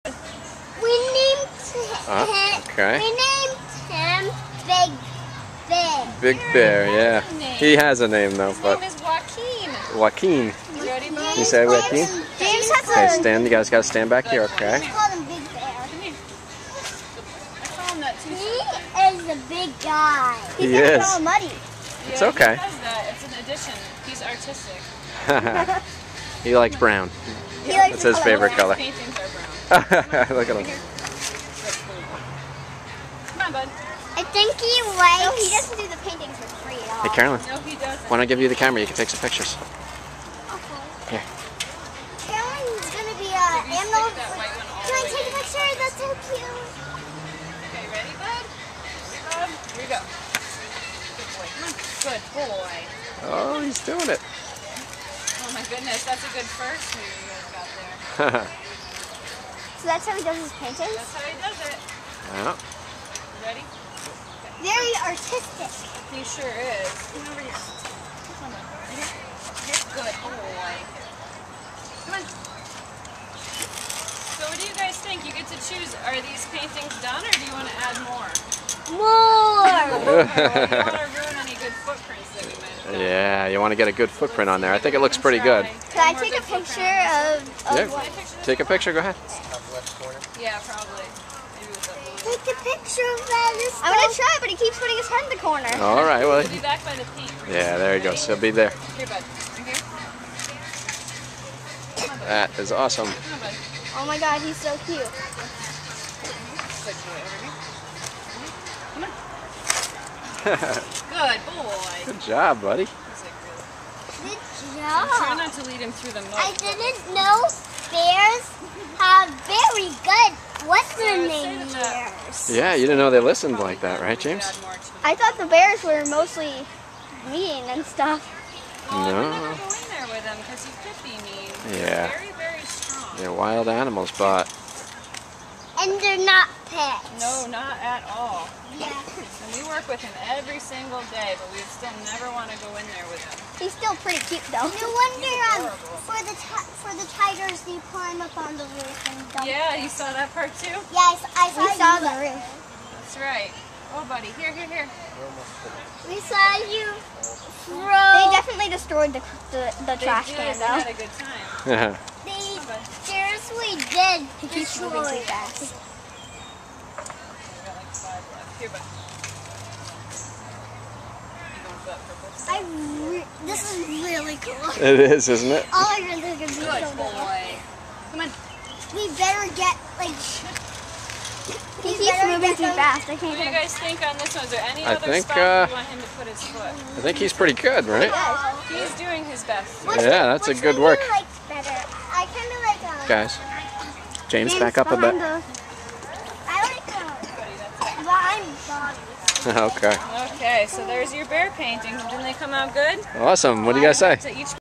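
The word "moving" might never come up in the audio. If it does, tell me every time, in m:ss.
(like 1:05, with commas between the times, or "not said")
2:44, 3:02.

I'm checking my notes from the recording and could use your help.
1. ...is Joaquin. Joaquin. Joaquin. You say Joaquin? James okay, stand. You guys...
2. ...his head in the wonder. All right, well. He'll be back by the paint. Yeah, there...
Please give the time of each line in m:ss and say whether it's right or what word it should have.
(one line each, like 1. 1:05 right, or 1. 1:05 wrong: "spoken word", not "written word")
1. 0:08 right
2. 1:34 wrong: "corner", not "wonder".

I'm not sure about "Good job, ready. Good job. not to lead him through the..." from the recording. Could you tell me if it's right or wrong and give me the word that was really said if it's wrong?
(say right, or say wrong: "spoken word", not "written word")
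wrong: "buddy", not "ready".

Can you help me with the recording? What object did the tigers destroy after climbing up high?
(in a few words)
The trash can.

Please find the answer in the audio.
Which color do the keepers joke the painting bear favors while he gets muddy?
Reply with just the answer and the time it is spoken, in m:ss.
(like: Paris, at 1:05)
Brown, at 0:26.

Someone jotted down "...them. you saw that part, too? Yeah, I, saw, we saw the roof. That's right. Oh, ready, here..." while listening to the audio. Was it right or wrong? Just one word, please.
wrong.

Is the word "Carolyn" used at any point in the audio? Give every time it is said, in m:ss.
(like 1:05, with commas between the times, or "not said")
0:37, 0:42.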